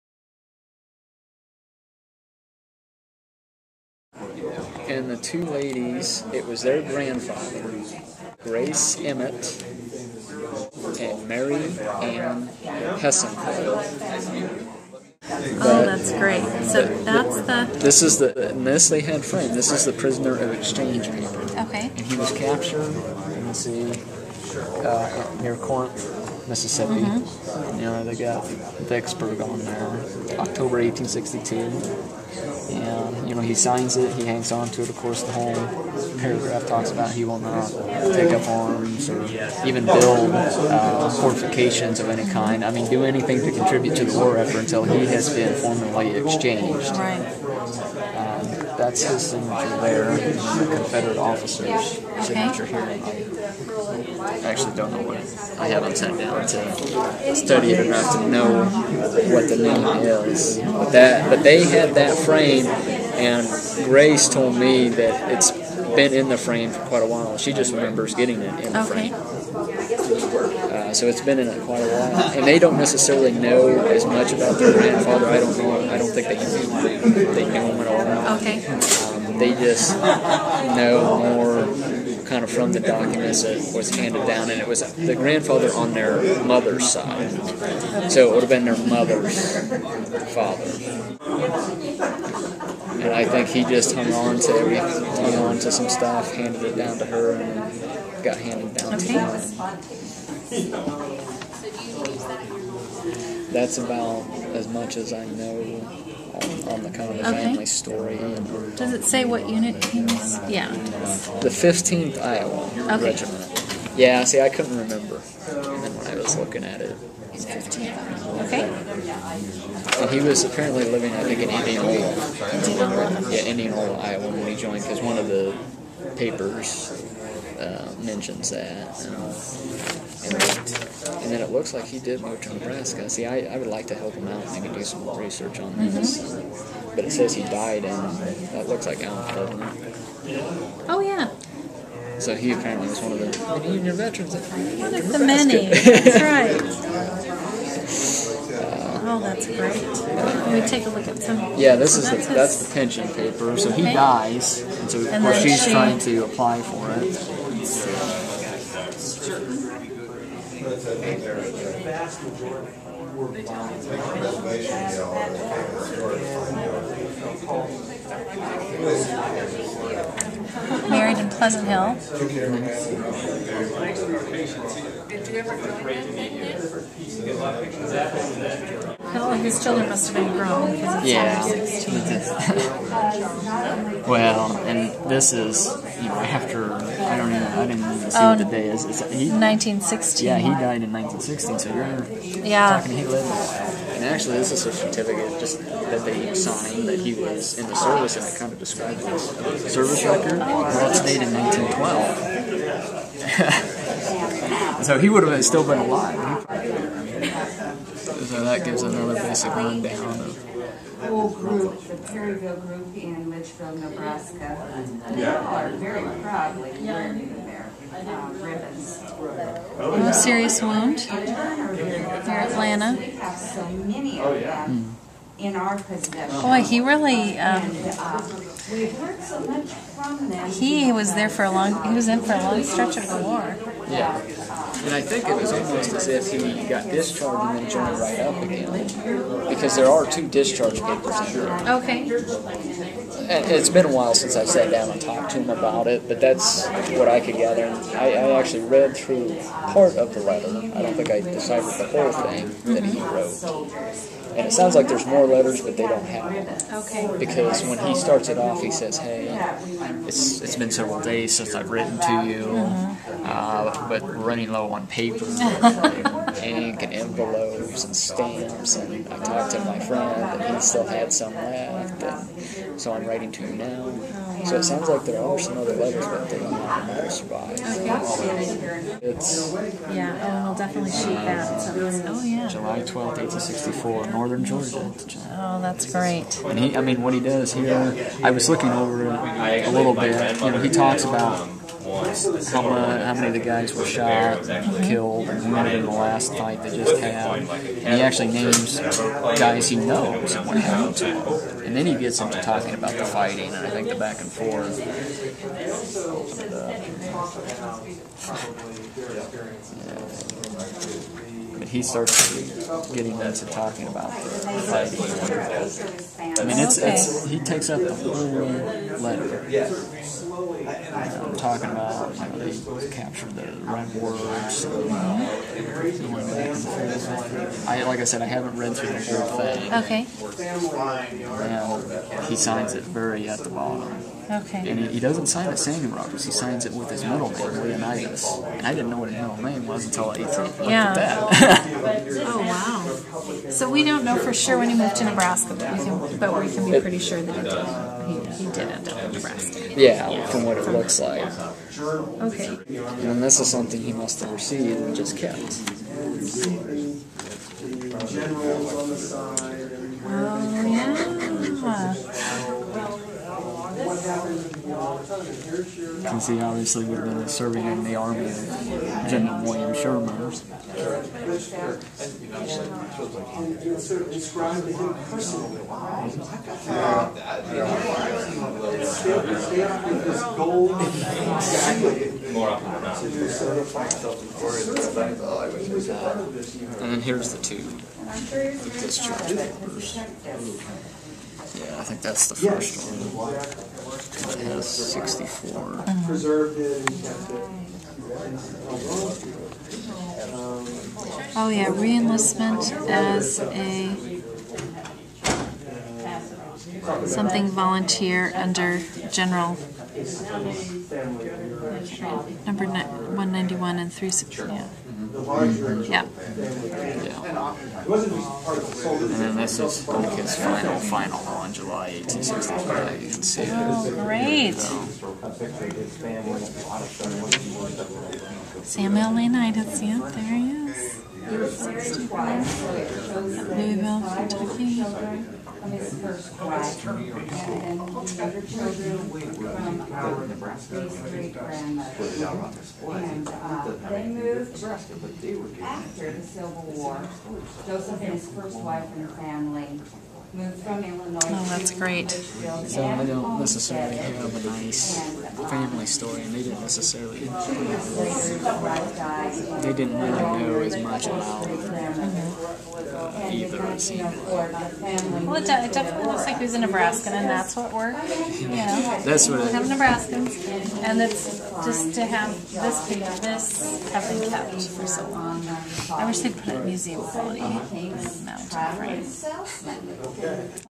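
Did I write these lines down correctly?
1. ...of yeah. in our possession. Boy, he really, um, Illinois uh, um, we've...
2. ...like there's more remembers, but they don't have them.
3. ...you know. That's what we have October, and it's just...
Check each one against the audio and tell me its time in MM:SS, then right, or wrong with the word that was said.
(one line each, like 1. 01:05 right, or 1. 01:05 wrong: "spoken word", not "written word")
1. 03:44 wrong: "And", not "Illinois"
2. 04:14 wrong: "letters", not "remembers"
3. 07:48 wrong: "Nebraskans", not "October".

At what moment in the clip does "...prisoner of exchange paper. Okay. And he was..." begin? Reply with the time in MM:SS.
00:19.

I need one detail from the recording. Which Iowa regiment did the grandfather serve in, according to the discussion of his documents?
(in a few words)
15th Iowa.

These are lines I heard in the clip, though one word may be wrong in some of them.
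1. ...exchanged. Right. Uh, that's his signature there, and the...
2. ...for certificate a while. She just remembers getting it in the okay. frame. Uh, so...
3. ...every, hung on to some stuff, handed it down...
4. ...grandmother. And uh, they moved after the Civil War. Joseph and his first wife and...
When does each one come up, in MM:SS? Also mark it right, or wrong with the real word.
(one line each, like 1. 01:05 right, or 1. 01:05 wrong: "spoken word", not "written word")
1. 00:46 right
2. 01:06 wrong: "quite", not "certificate"
3. 01:34 right
4. 07:21 right.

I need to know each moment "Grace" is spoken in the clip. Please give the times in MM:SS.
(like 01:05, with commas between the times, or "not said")
00:08, 01:03.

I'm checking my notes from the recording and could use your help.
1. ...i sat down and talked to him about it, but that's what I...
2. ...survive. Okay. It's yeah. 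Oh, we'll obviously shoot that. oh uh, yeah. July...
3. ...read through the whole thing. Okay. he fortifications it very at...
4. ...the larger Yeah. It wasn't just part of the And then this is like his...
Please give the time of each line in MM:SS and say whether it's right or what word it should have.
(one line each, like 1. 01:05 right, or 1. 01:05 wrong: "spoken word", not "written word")
1. 04:04 right
2. 04:37 wrong: "definitely", not "obviously"
3. 05:28 wrong: "signs", not "fortifications"
4. 06:55 right.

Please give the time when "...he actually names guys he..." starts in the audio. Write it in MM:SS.
04:57.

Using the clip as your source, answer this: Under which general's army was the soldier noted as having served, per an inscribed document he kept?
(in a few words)
William Sherman.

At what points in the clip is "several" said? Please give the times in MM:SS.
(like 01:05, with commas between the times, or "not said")
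04:20.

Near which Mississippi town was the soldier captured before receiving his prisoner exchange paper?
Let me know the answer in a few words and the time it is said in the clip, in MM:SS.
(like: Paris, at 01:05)
Corinth, at 00:25.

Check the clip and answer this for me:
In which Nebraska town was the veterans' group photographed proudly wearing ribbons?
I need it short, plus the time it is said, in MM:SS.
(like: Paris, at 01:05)
Litchfield, at 03:33.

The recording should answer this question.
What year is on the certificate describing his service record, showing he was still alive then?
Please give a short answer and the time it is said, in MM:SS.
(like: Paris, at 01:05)
1912, at 03:21.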